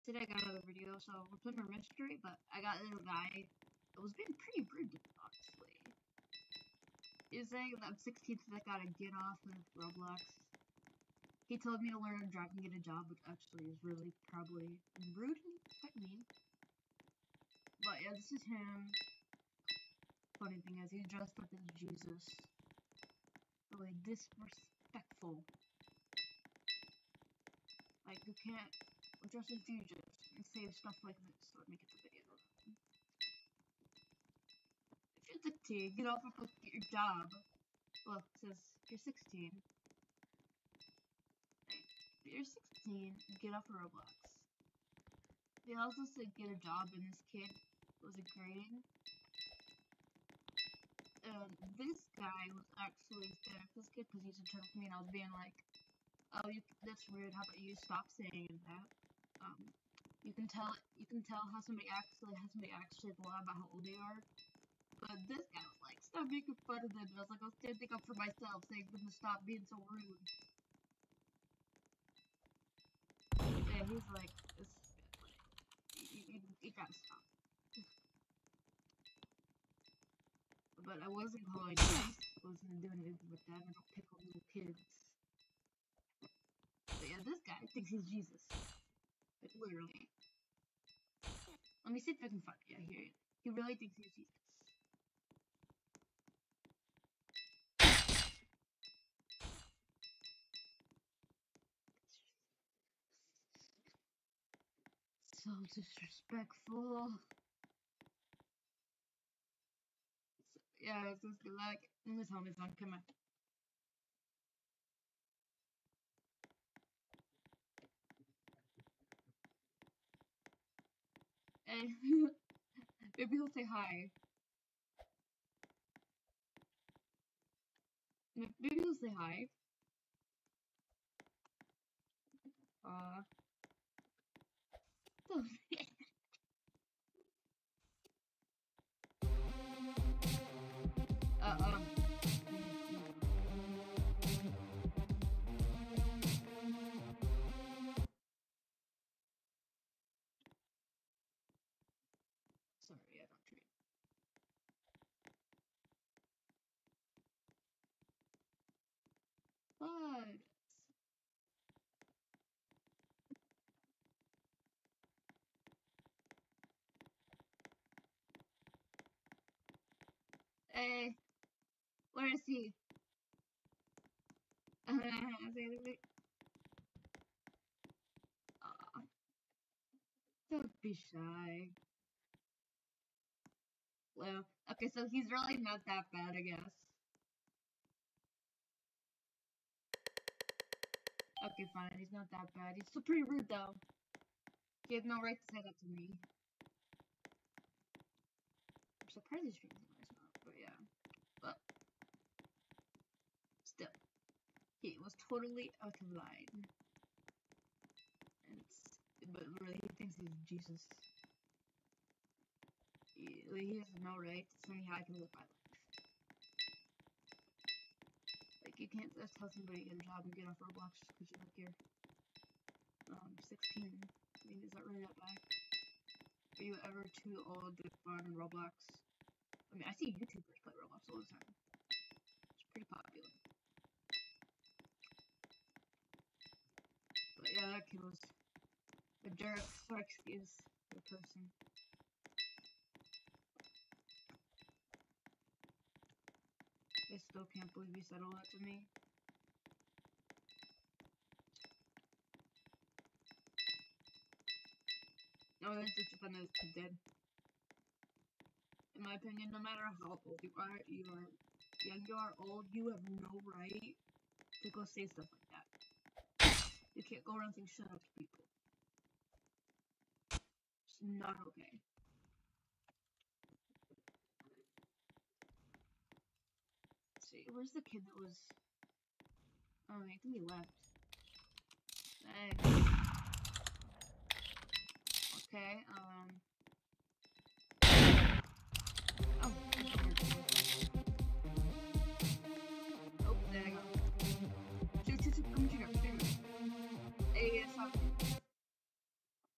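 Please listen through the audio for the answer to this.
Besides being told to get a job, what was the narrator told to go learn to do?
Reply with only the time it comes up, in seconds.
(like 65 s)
12 s.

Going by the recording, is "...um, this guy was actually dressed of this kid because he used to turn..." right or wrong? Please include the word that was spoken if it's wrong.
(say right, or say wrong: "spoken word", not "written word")
wrong: "scared", not "dressed".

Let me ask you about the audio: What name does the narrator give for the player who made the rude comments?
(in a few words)
Derek Fletch.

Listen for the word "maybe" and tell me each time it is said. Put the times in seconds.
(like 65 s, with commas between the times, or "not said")
123 s, 128 s.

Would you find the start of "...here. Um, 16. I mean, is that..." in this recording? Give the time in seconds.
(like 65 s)
221 s.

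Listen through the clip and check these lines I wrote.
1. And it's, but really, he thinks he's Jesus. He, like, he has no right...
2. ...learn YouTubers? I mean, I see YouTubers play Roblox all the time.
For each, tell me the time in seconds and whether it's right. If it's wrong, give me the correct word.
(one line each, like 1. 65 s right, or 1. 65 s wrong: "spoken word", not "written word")
1. 206 s right
2. 228 s wrong: "Roblox", not "YouTubers".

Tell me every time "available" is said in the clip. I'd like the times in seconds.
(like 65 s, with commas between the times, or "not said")
not said.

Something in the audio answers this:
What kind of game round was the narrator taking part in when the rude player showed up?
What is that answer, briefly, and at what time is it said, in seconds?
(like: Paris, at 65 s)
Mystery, at 1 s.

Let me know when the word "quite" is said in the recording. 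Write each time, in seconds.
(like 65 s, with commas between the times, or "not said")
15 s.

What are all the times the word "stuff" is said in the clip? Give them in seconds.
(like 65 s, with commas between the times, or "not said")
30 s, 265 s.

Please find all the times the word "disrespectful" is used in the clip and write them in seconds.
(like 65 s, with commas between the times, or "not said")
24 s, 105 s.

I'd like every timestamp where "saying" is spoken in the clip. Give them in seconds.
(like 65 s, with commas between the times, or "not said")
7 s, 58 s, 68 s, 267 s.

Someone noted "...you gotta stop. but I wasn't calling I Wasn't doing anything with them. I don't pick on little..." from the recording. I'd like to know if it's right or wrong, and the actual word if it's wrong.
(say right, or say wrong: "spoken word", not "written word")
right.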